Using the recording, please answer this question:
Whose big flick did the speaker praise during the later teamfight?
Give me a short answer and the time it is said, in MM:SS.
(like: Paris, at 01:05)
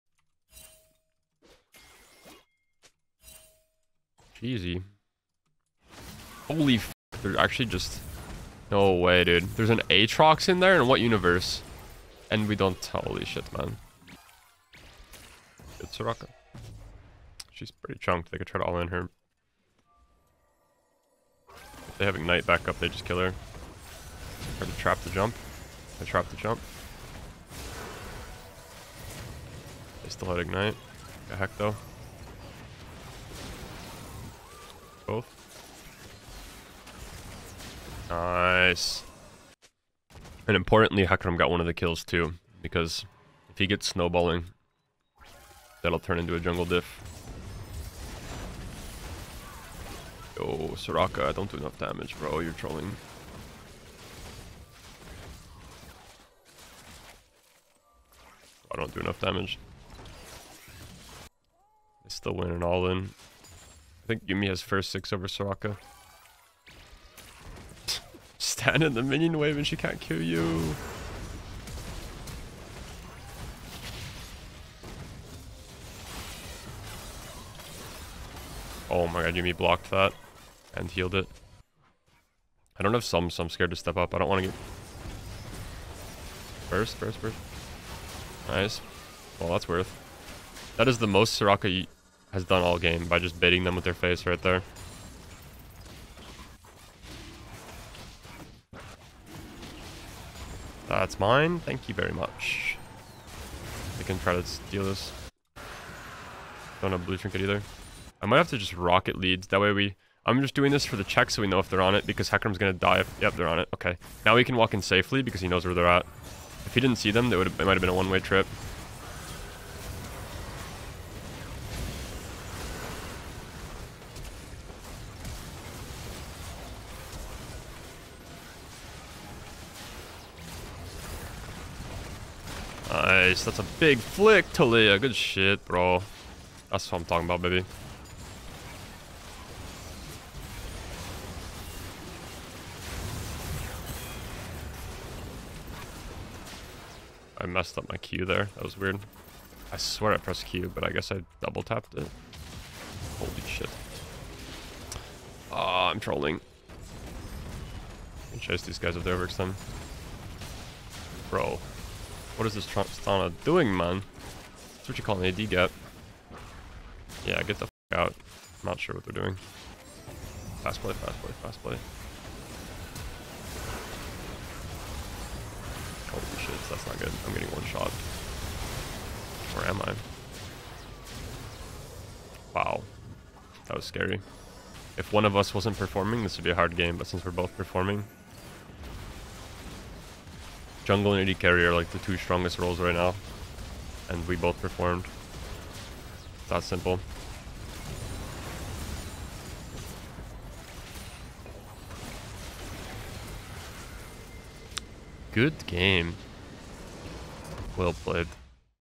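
Taliyah, at 02:14.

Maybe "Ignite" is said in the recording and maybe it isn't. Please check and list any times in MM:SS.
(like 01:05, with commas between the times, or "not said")
00:22, 00:30.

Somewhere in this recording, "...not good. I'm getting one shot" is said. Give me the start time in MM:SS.
02:56.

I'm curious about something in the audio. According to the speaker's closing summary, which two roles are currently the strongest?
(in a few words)
Jungle and AD Carry.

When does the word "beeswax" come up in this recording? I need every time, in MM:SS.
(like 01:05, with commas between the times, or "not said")
not said.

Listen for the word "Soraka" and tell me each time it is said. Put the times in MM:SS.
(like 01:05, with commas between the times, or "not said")
00:15, 00:50, 01:05, 01:31.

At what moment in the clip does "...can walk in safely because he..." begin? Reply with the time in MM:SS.
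01:54.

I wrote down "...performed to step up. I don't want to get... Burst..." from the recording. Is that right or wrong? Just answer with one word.
wrong.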